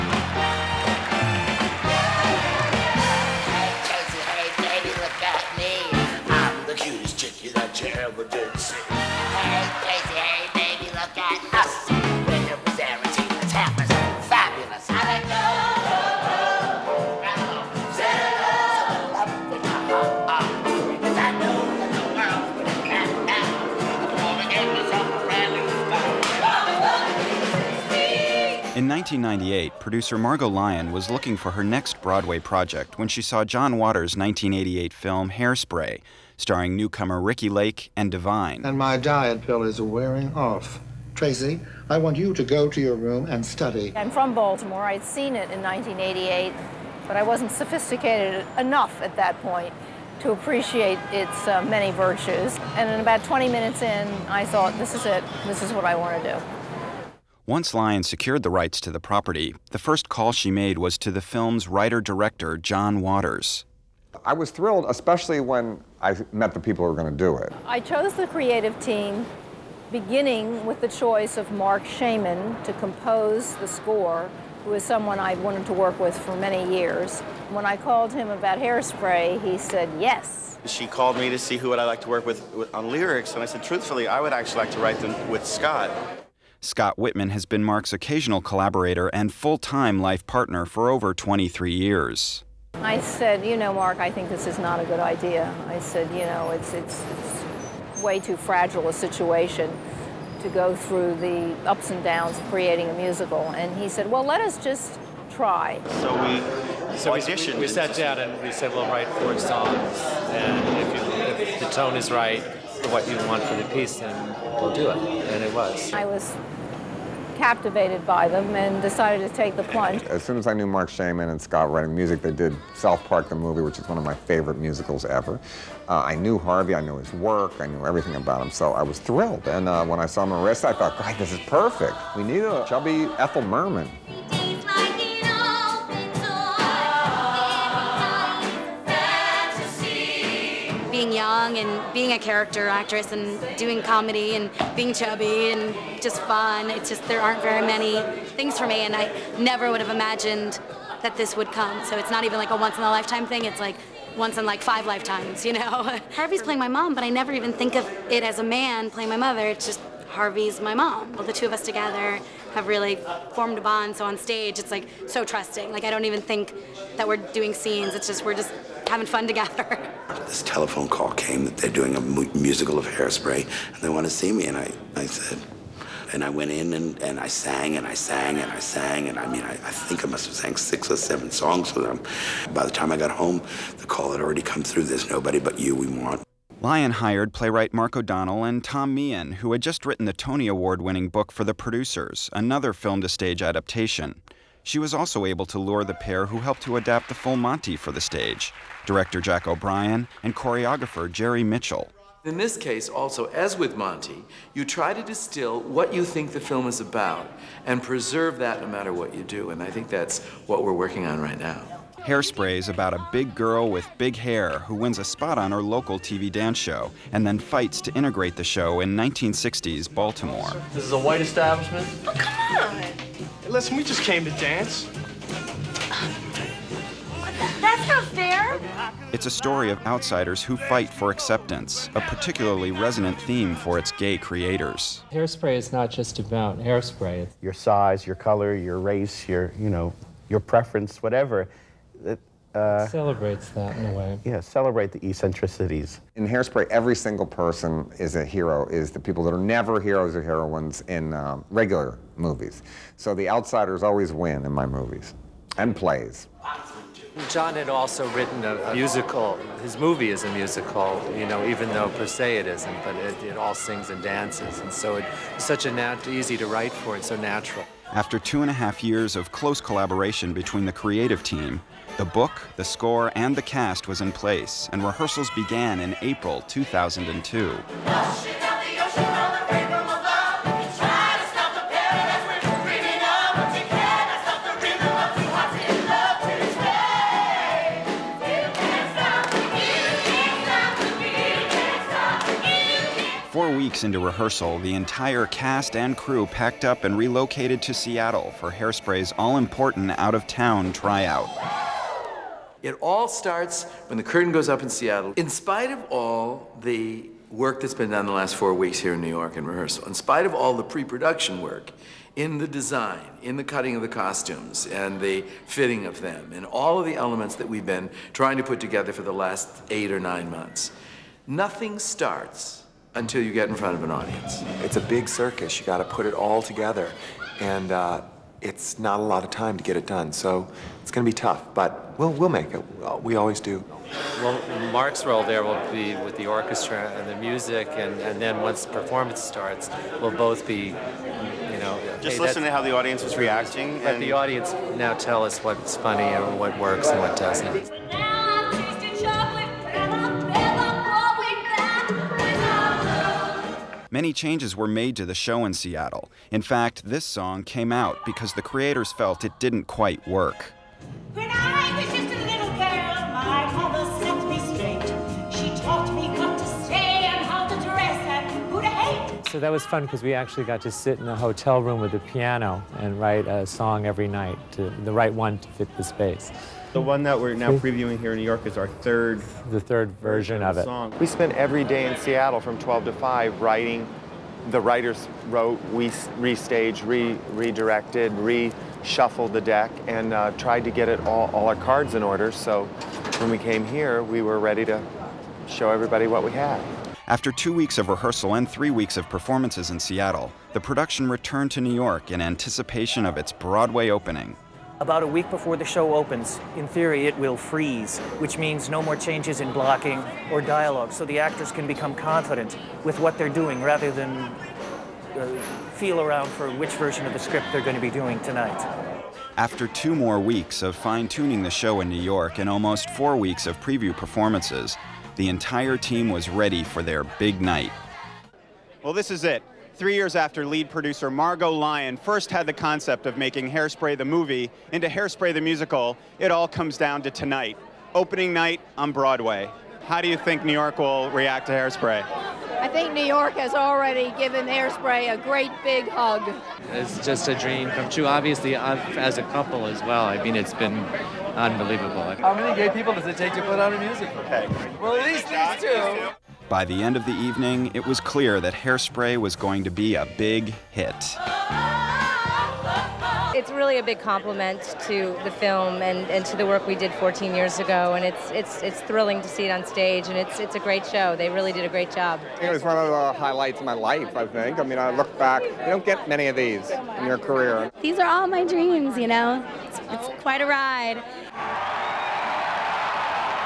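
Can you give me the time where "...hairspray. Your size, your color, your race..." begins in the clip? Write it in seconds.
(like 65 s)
236 s.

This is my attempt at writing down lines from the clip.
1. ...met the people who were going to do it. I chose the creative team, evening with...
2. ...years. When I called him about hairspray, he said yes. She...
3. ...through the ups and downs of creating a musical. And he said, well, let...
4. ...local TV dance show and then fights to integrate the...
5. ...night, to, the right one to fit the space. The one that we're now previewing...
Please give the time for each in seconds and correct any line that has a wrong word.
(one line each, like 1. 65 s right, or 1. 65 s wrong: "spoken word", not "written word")
1. 66 s wrong: "beginning", not "evening"
2. 76 s right
3. 100 s right
4. 215 s right
5. 374 s right.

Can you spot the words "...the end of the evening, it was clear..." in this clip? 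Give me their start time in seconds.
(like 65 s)
456 s.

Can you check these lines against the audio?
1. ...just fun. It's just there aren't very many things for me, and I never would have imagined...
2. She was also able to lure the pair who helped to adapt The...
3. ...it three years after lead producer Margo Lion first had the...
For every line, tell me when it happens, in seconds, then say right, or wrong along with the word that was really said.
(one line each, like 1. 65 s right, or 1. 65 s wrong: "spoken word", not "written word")
1. 146 s right
2. 194 s right
3. 429 s right.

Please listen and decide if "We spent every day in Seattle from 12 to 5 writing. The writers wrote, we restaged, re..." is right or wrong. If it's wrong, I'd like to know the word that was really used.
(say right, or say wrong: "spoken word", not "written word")
right.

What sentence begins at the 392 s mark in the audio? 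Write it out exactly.
So when we came here, we were ready to show everybody what we had.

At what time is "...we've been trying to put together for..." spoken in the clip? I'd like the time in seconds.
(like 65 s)
317 s.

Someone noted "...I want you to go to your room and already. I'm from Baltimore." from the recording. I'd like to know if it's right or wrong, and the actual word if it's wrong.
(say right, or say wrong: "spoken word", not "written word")
wrong: "study", not "already".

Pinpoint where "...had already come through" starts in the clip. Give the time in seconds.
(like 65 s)
184 s.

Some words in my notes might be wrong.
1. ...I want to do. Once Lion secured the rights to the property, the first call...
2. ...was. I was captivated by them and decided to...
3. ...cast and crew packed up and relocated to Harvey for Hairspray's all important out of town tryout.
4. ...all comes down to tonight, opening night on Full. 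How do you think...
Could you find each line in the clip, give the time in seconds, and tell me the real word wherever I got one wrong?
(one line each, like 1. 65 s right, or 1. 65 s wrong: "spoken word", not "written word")
1. 55 s right
2. 115 s right
3. 295 s wrong: "Seattle", not "Harvey"
4. 436 s wrong: "Broadway", not "Full".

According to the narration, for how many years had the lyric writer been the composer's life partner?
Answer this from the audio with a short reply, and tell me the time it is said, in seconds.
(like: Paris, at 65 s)
23 years, at 91 s.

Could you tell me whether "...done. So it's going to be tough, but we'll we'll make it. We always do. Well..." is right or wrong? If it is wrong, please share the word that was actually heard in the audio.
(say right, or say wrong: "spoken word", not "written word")
right.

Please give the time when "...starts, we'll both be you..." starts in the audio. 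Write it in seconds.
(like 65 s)
339 s.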